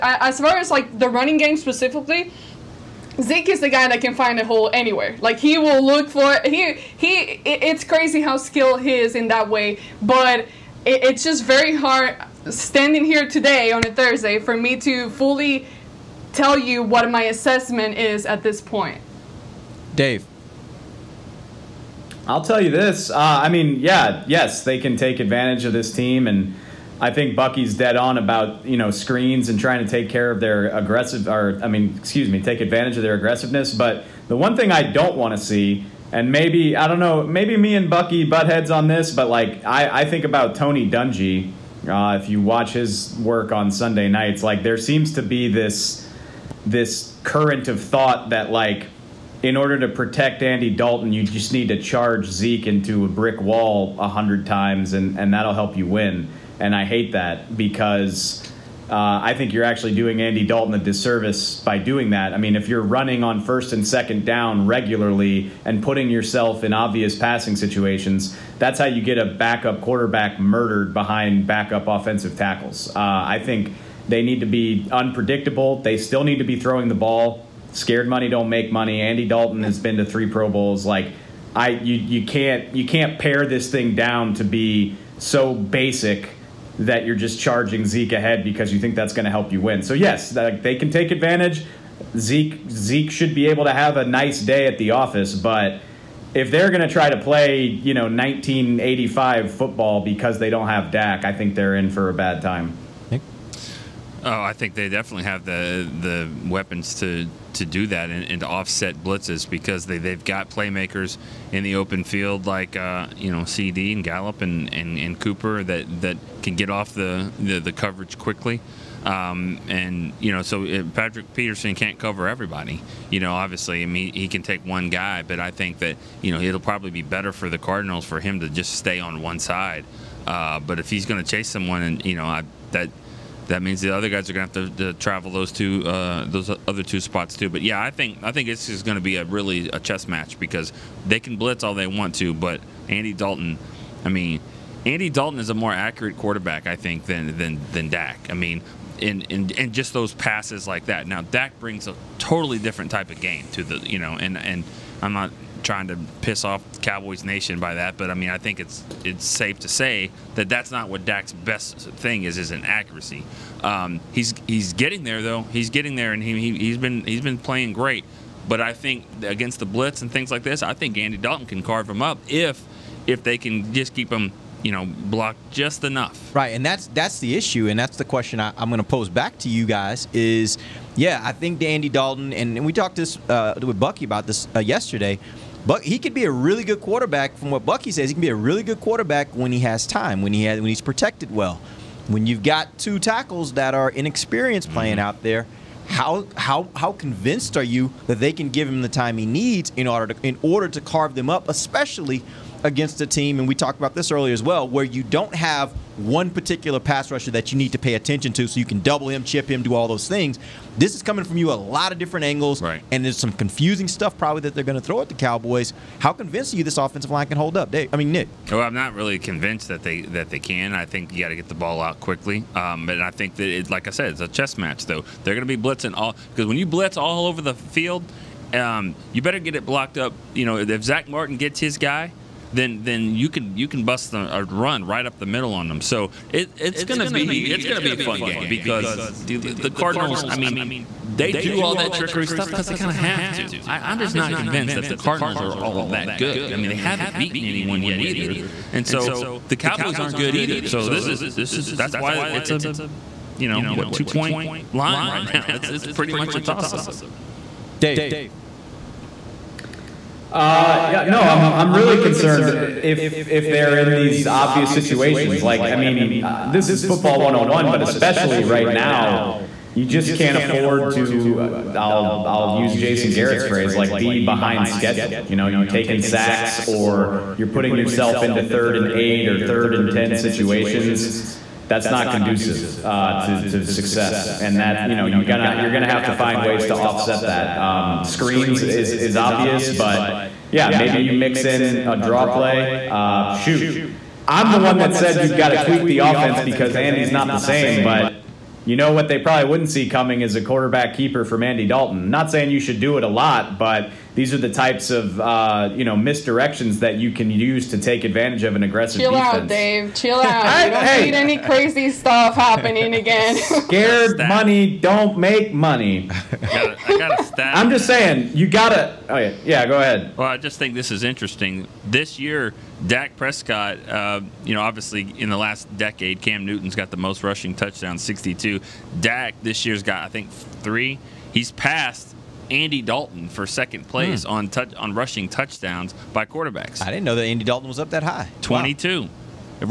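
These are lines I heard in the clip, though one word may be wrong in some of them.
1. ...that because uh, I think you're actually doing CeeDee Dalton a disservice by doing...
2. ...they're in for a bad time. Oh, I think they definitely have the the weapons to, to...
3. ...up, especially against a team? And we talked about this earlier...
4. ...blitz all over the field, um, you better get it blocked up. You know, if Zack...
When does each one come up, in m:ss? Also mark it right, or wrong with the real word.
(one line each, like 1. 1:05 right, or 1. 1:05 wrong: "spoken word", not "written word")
1. 0:57 wrong: "Andy", not "CeeDee"
2. 1:41 right
3. 3:21 right
4. 3:46 right.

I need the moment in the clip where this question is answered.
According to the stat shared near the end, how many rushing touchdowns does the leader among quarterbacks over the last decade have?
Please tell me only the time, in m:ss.
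5:28.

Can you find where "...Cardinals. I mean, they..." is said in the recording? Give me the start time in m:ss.
3:59.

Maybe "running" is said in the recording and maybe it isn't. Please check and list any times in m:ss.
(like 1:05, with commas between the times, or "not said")
0:01, 1:02.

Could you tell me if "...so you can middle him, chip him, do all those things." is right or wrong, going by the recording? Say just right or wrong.
wrong.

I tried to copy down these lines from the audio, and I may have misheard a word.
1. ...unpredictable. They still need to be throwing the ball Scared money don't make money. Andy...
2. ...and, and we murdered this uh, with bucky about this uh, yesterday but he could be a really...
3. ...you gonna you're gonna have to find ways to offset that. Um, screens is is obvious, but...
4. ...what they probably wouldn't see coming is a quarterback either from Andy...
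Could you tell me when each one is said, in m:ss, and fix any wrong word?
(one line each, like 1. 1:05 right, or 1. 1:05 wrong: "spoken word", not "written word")
1. 1:14 right
2. 3:02 wrong: "talked", not "murdered"
3. 4:45 right
4. 4:58 wrong: "keeper", not "either".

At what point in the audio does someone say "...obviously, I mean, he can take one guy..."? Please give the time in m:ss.
2:03.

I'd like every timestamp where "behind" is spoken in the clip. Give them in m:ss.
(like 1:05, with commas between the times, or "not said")
1:10, 4:34.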